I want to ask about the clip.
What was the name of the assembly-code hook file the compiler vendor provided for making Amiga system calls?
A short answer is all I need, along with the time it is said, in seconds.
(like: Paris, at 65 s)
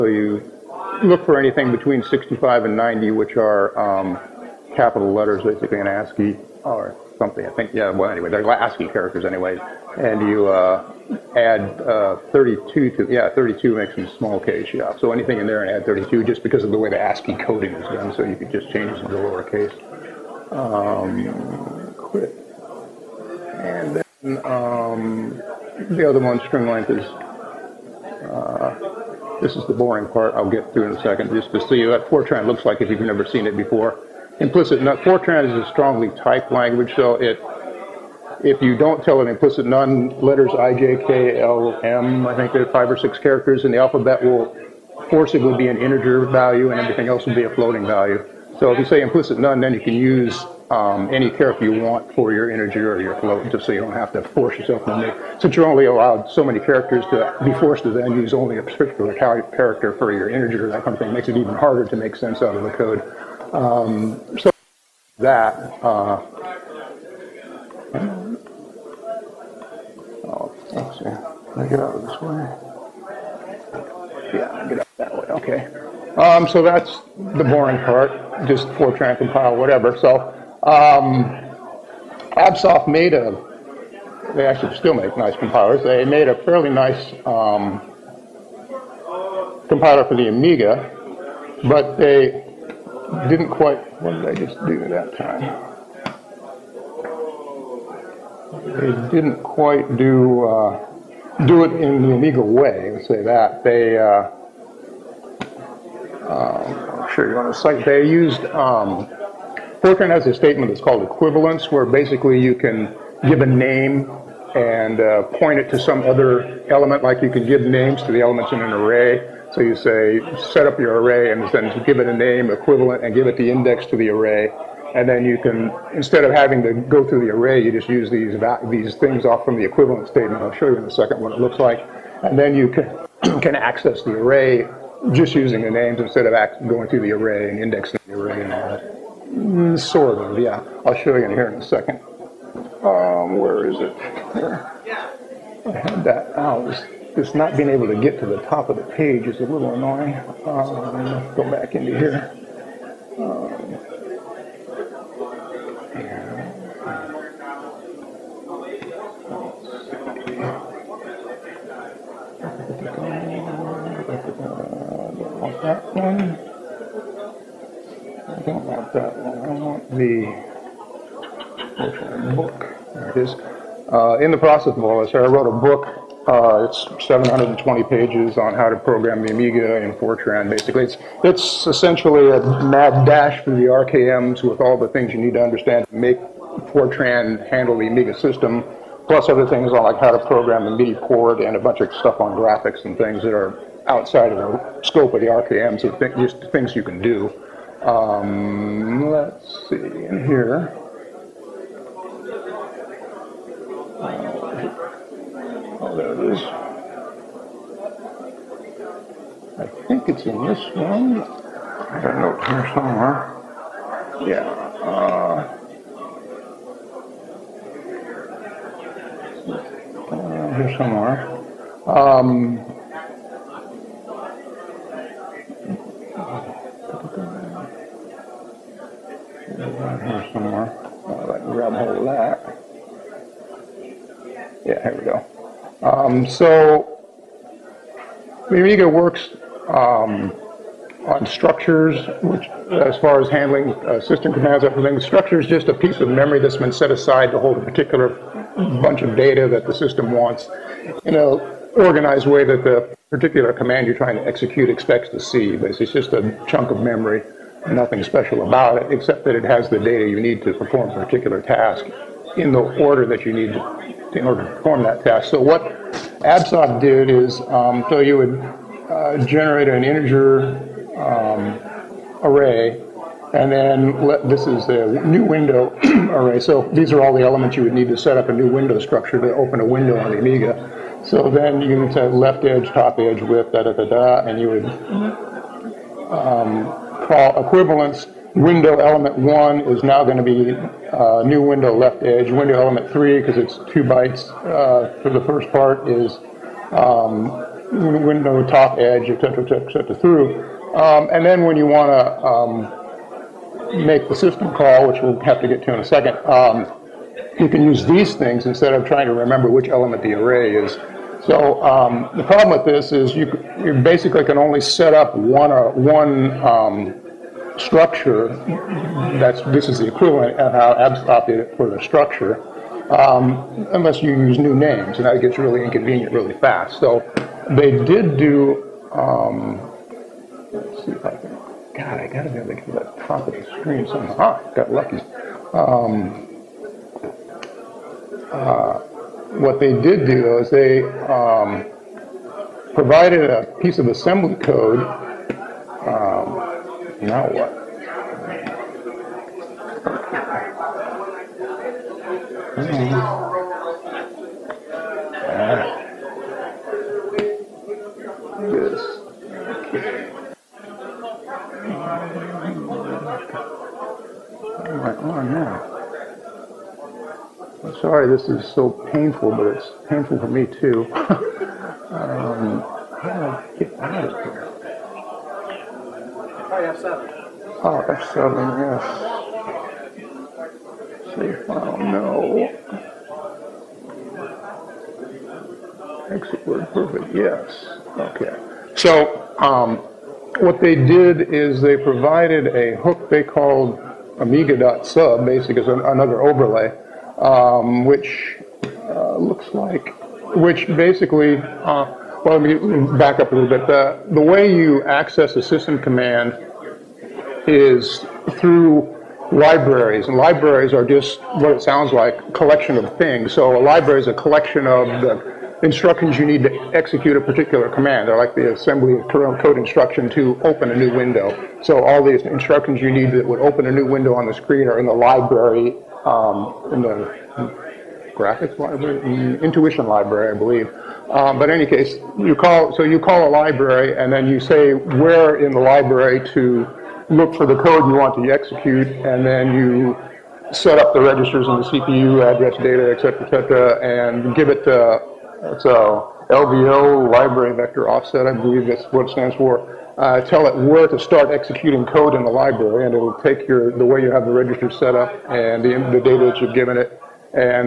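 amiga.sub, at 394 s.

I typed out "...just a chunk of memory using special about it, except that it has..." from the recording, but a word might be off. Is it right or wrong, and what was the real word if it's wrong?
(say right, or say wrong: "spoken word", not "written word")
wrong: "nothing", not "using".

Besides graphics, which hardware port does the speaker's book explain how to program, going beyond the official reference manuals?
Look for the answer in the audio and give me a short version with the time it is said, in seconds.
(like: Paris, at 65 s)
MIDI port, at 190 s.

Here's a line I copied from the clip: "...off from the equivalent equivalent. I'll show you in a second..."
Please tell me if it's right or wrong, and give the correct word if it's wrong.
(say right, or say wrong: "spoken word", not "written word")
wrong: "statement", not "equivalent".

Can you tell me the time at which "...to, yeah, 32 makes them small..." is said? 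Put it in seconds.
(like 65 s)
12 s.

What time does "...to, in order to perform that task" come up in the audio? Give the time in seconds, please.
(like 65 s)
263 s.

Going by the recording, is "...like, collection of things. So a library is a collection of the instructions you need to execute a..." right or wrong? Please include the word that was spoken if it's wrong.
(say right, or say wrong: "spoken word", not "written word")
right.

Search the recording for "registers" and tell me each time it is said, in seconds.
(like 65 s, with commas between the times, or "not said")
440 s, 454 s.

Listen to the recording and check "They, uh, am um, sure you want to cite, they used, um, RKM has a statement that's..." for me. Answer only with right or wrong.
wrong.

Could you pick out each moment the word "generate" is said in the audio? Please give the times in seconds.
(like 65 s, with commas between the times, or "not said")
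269 s.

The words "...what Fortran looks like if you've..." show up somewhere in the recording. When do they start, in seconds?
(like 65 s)
31 s.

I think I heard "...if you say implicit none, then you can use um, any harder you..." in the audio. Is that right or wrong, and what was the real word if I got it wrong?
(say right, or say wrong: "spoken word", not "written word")
wrong: "character", not "harder".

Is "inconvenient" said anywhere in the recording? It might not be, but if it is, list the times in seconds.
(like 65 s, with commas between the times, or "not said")
325 s.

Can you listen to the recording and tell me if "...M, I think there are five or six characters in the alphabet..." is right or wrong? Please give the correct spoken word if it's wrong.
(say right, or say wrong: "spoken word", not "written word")
right.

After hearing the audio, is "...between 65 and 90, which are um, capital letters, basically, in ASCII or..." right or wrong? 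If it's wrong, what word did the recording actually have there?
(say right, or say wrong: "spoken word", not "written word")
right.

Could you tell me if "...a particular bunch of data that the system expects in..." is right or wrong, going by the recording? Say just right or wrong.
wrong.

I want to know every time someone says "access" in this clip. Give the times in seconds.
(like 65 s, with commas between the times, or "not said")
133 s, 404 s.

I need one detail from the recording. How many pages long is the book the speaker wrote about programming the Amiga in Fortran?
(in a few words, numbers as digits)
720.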